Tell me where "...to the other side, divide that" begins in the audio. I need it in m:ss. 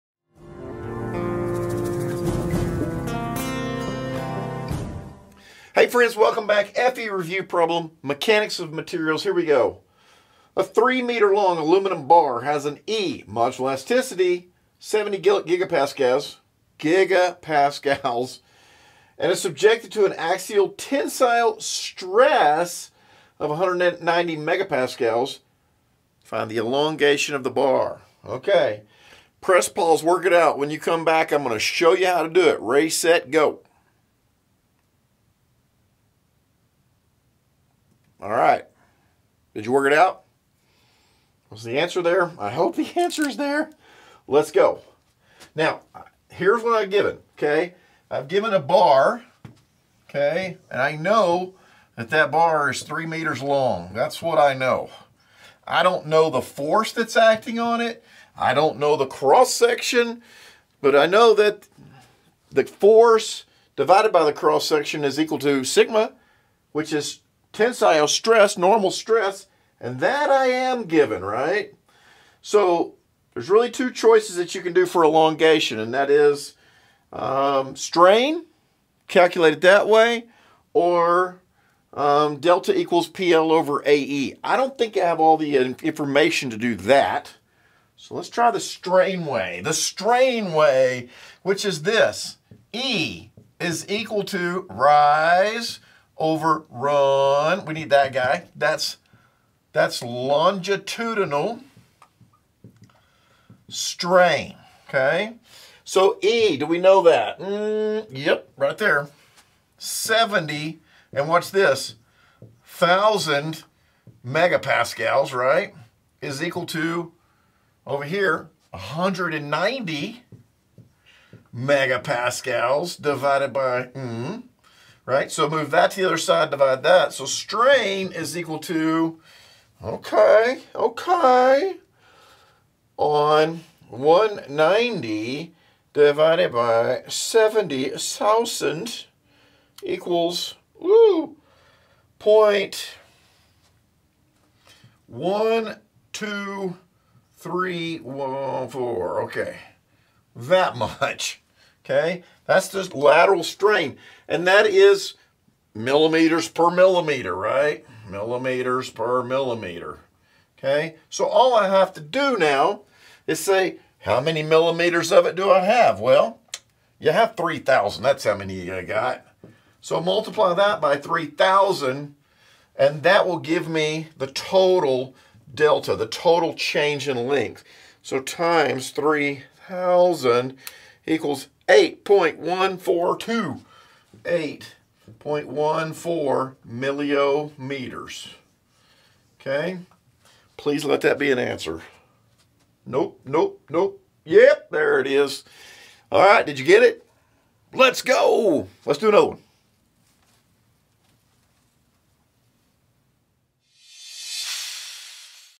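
2:05.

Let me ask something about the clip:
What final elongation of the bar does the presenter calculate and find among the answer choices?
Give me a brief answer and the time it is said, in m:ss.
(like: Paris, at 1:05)
8.14 millimeters, at 3:04.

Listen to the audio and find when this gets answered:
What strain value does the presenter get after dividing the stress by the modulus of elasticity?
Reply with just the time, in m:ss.
2:22.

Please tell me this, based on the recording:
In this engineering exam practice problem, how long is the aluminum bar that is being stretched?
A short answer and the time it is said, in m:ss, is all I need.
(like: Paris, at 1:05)
3 meters, at 0:10.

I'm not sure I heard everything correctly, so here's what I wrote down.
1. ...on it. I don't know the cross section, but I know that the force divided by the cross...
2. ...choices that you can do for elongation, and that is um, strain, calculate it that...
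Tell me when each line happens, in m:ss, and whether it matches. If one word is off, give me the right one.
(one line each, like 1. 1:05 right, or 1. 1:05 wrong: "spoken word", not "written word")
1. 0:57 right
2. 1:13 right.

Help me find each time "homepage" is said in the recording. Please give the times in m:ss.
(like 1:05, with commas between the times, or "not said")
not said.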